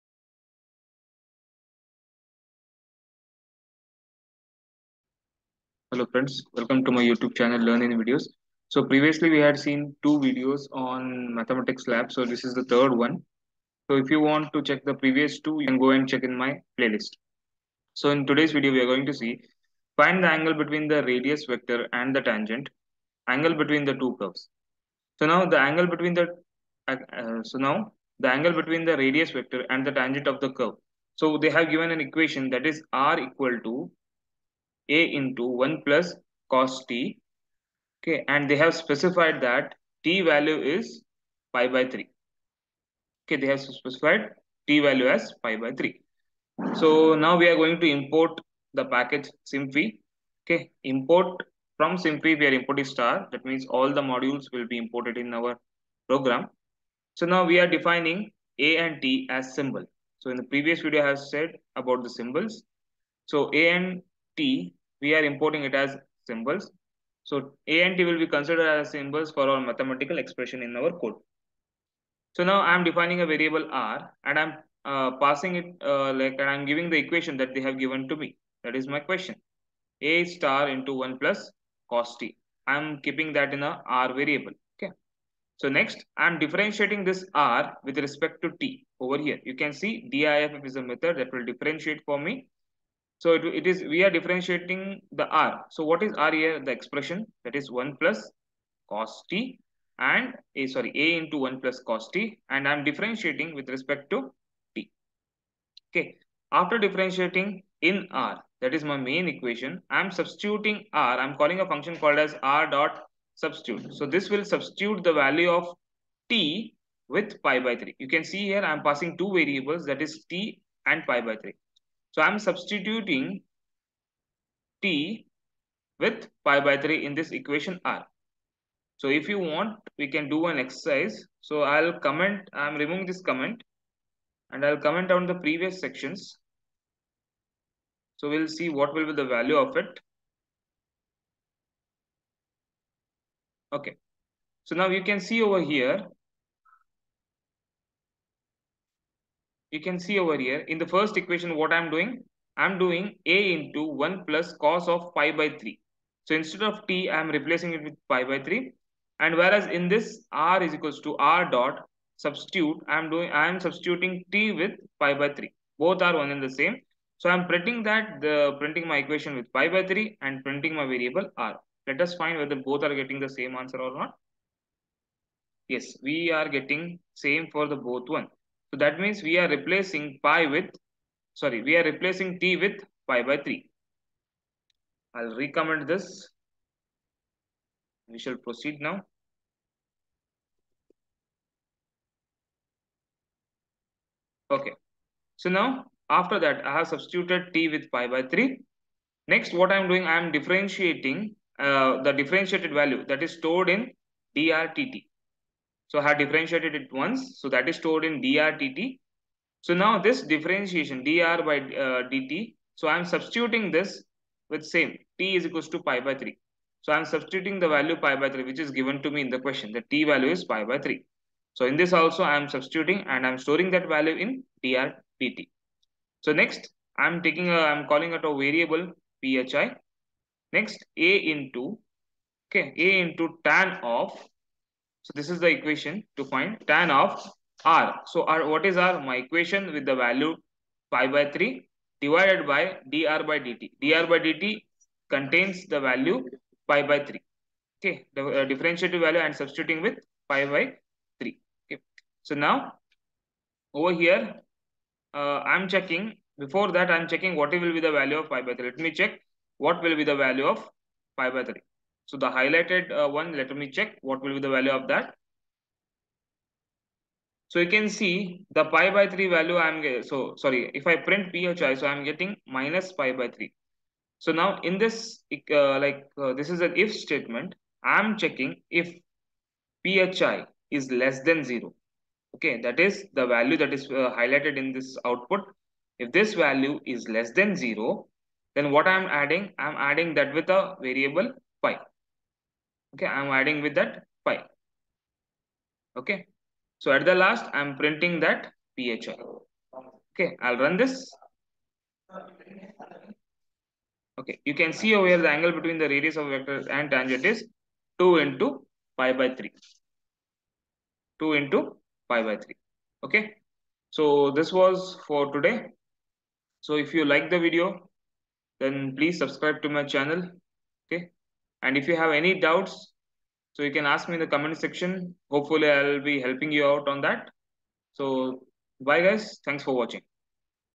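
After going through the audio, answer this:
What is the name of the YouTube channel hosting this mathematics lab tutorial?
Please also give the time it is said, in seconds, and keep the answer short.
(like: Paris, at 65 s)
Learn in Videos, at 7 s.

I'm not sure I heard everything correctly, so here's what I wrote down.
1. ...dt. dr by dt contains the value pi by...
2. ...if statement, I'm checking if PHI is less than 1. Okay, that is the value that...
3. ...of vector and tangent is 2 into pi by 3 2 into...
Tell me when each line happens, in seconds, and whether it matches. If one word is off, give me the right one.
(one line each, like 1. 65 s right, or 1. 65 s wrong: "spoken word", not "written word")
1. 243 s right
2. 276 s wrong: "0", not "1"
3. 306 s right.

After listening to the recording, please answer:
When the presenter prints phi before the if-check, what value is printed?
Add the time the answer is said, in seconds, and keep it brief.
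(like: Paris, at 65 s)
minus pi by 3, at 272 s.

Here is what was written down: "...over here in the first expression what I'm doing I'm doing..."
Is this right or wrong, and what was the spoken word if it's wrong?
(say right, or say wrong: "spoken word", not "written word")
wrong: "equation", not "expression".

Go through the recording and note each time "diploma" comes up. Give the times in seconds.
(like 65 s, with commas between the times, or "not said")
not said.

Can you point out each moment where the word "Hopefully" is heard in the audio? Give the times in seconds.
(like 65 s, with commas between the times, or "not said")
325 s.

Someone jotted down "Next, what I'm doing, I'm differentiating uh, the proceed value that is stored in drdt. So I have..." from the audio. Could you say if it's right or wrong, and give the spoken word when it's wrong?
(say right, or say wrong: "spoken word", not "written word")
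wrong: "differentiated", not "proceed".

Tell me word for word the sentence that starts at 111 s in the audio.
I'm calling a function called as R dot substitute.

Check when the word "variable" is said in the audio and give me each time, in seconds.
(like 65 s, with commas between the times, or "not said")
73 s, 84 s, 119 s, 170 s, 228 s, 290 s.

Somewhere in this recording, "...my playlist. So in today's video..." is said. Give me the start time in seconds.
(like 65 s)
16 s.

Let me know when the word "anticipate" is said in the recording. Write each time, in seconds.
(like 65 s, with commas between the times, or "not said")
not said.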